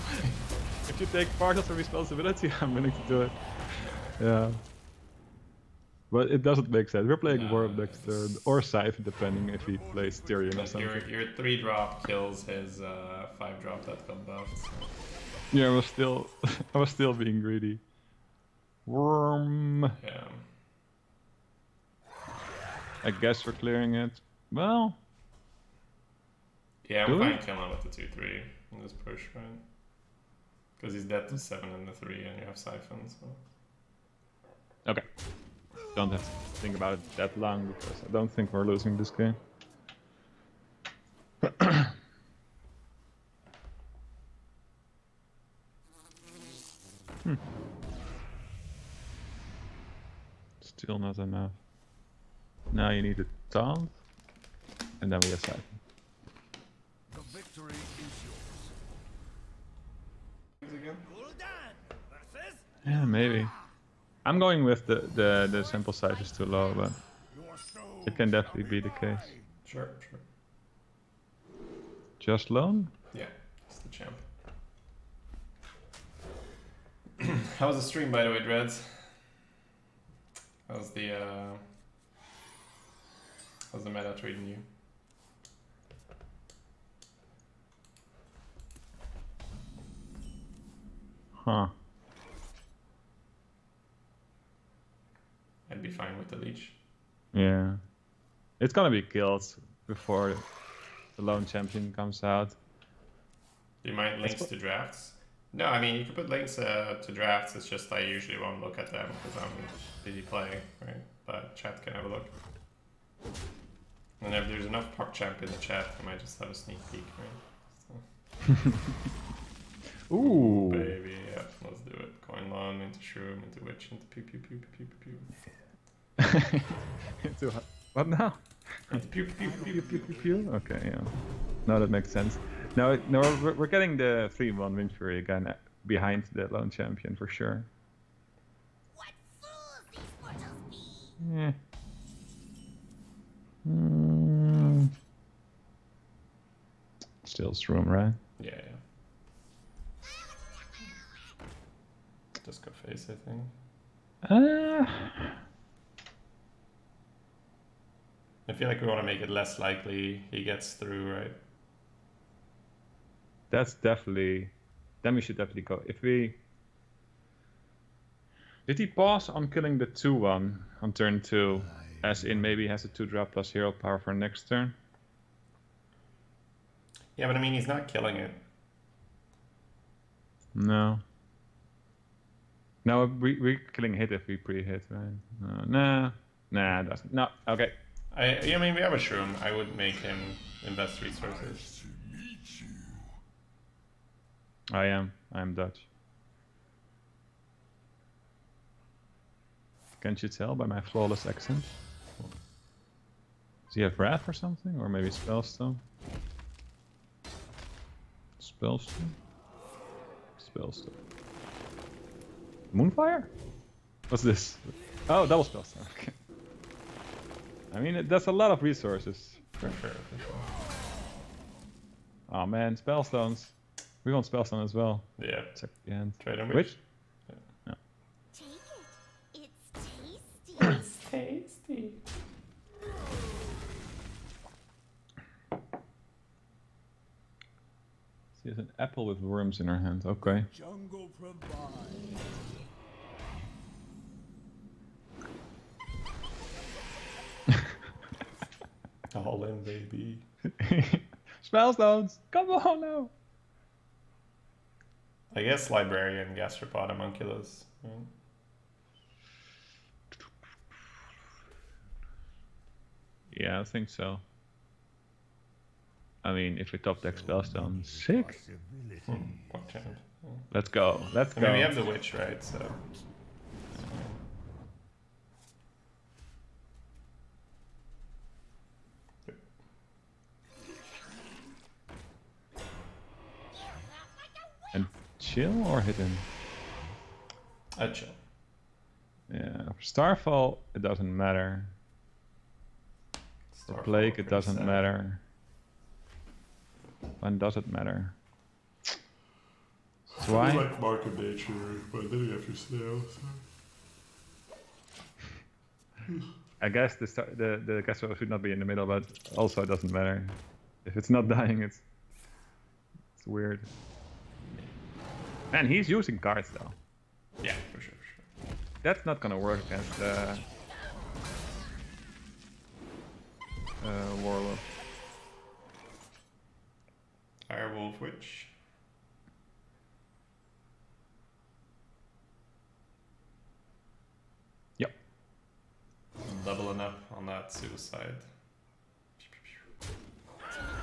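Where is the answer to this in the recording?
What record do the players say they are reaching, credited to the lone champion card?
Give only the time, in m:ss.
2:14.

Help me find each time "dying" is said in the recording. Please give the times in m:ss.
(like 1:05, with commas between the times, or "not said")
5:11.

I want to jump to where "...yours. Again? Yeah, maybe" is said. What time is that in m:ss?
1:00.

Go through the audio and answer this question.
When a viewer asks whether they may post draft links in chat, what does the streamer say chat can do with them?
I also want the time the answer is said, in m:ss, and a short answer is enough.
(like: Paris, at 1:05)
Have a look, at 1:51.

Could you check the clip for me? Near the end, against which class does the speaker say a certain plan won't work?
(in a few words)
Warlock.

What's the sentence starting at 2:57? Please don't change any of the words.
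Yeah, but I mean, he's not killing it.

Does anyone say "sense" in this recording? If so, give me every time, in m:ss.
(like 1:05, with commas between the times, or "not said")
0:06, 2:12.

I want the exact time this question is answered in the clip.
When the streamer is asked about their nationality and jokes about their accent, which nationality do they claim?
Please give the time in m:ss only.
3:15.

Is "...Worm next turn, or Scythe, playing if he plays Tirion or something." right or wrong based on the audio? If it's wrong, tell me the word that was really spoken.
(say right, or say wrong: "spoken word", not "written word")
wrong: "depending", not "playing".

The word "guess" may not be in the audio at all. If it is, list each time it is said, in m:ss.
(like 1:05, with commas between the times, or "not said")
0:23, 4:15, 5:06.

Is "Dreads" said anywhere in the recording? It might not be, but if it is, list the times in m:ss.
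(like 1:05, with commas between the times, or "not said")
1:18.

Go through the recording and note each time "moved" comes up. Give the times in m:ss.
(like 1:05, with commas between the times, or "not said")
not said.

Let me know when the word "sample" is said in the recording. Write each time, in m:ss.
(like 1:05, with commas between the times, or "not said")
1:05.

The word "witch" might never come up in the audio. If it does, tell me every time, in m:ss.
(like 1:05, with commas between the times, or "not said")
2:03, 4:31, 5:27.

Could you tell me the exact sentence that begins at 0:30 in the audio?
Because he's dead to 7 and the 3, and you have Siphon, so.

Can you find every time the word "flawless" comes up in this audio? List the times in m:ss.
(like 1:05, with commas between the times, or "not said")
3:20.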